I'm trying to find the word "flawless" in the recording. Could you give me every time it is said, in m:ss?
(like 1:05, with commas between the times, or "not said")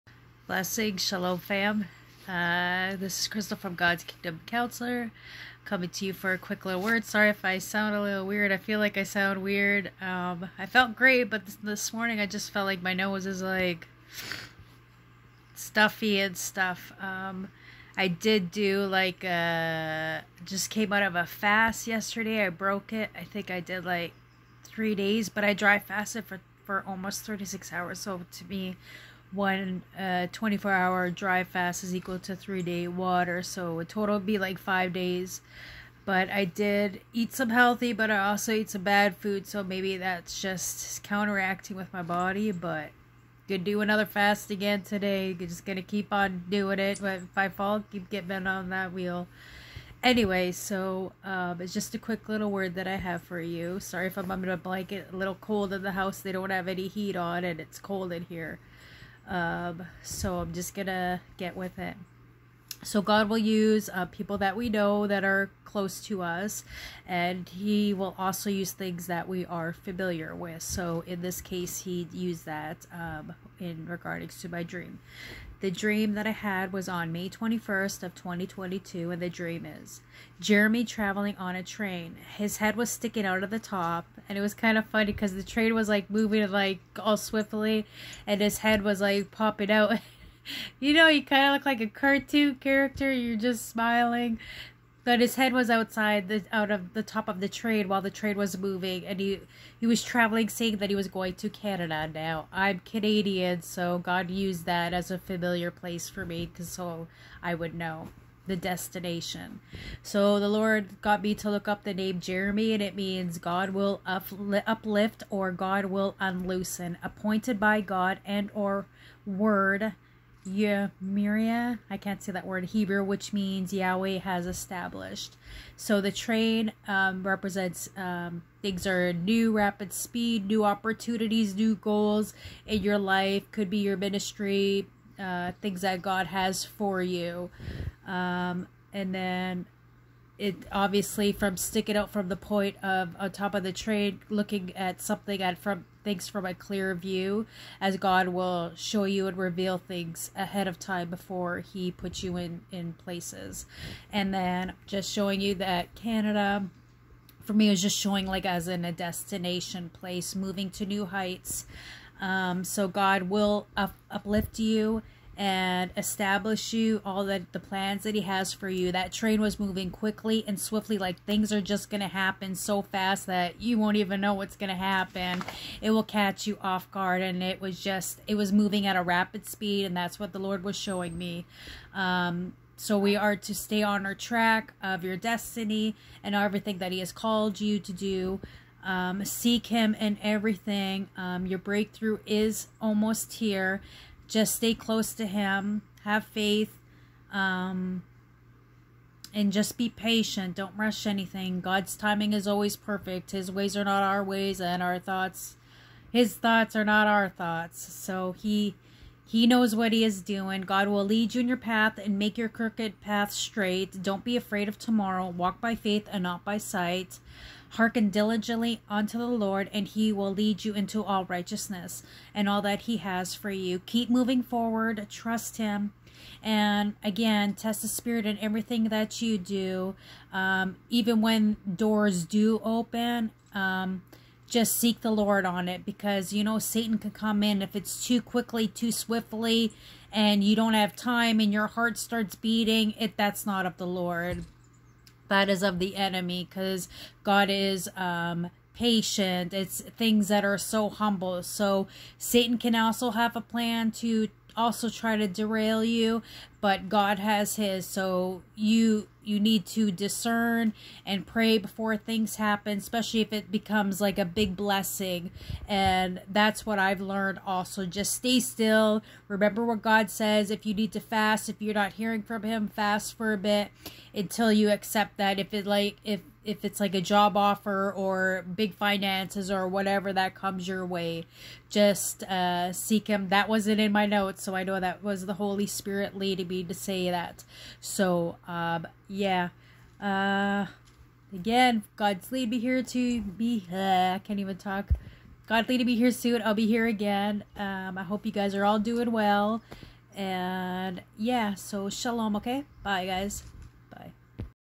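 not said.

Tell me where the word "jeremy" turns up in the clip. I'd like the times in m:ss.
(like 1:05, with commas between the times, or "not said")
1:20, 1:52.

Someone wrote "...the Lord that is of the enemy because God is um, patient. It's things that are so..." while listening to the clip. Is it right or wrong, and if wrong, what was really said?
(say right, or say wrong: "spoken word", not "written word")
right.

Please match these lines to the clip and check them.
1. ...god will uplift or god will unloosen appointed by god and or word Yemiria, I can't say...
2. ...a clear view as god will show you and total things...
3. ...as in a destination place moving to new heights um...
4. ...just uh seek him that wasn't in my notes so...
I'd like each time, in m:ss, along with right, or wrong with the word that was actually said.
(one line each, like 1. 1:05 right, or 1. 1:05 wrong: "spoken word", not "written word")
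1. 1:53 right
2. 2:26 wrong: "reveal", not "total"
3. 2:38 right
4. 4:41 right.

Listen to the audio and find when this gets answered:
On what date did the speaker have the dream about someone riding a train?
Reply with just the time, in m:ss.
1:17.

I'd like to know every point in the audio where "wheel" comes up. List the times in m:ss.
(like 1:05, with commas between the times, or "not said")
0:48.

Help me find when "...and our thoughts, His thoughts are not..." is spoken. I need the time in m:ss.
3:24.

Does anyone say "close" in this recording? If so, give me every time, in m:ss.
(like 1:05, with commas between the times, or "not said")
1:05, 3:14.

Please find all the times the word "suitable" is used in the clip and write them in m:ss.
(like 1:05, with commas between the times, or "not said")
not said.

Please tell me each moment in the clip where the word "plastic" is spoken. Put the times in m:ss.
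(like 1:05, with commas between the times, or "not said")
not said.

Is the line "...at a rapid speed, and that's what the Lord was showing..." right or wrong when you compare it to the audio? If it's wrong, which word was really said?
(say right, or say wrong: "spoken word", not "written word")
right.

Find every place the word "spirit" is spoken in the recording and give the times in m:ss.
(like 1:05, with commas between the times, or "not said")
3:47, 4:45.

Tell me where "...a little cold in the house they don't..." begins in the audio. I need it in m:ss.
0:55.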